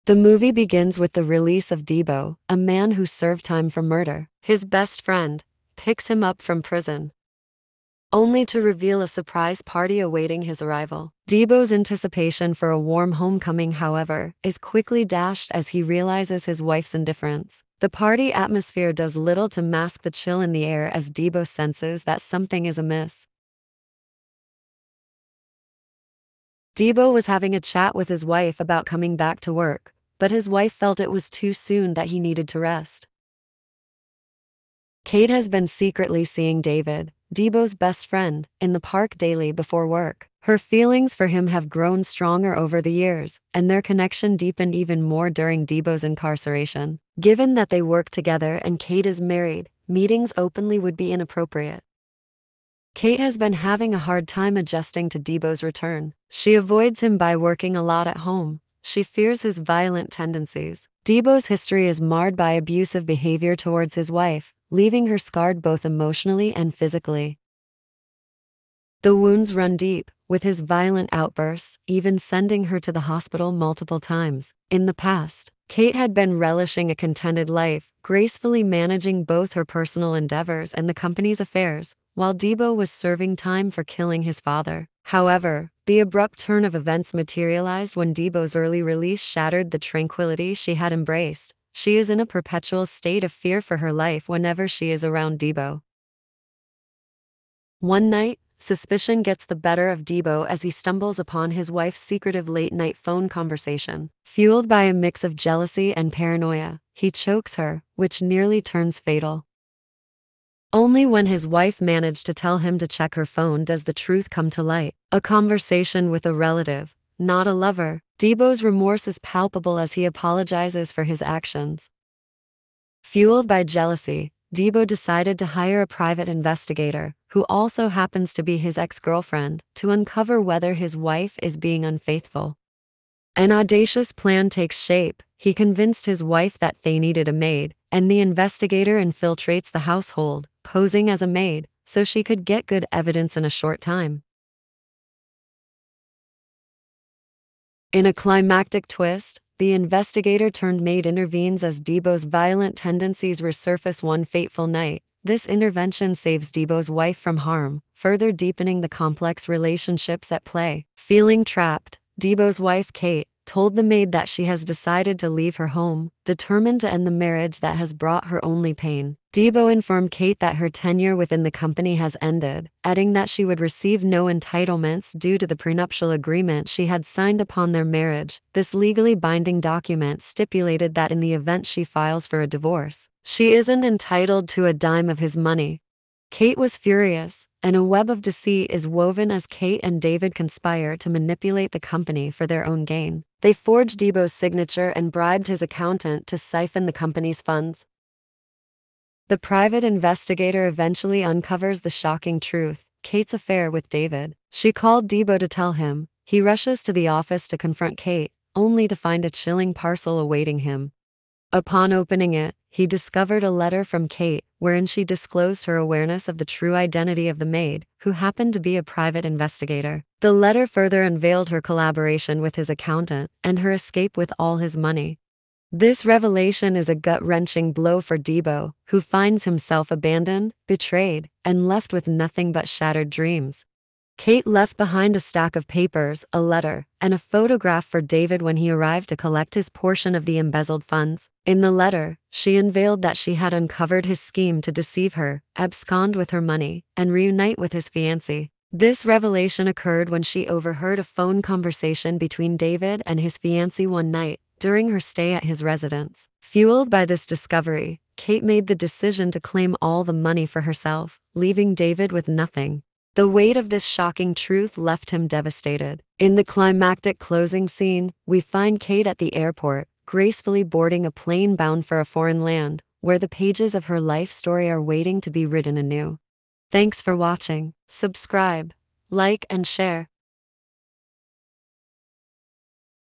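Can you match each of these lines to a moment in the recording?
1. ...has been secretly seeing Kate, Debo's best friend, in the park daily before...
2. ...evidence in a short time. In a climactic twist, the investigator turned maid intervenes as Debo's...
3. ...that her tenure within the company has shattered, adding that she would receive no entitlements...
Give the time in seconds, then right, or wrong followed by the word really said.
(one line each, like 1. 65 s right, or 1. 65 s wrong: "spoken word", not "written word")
1. 35 s wrong: "David", not "Kate"
2. 142 s right
3. 170 s wrong: "ended", not "shattered".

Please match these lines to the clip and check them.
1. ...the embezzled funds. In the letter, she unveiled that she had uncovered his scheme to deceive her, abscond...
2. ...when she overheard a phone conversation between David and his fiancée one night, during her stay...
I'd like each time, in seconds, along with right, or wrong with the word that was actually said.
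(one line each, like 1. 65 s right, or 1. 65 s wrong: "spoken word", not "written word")
1. 240 s right
2. 250 s right.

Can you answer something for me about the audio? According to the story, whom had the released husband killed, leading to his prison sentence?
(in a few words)
His father.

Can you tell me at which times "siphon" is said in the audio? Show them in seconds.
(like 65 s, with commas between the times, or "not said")
196 s.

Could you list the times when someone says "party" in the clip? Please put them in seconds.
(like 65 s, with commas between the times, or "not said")
9 s, 17 s.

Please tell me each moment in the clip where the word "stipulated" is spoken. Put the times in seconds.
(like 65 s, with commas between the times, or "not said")
180 s.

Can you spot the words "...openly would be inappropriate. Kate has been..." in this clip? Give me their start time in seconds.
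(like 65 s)
50 s.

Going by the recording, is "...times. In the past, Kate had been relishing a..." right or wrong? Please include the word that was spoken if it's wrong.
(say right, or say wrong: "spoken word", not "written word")
right.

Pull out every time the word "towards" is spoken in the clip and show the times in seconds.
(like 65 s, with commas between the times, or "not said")
63 s.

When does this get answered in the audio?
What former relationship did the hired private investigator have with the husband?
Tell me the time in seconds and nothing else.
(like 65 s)
128 s.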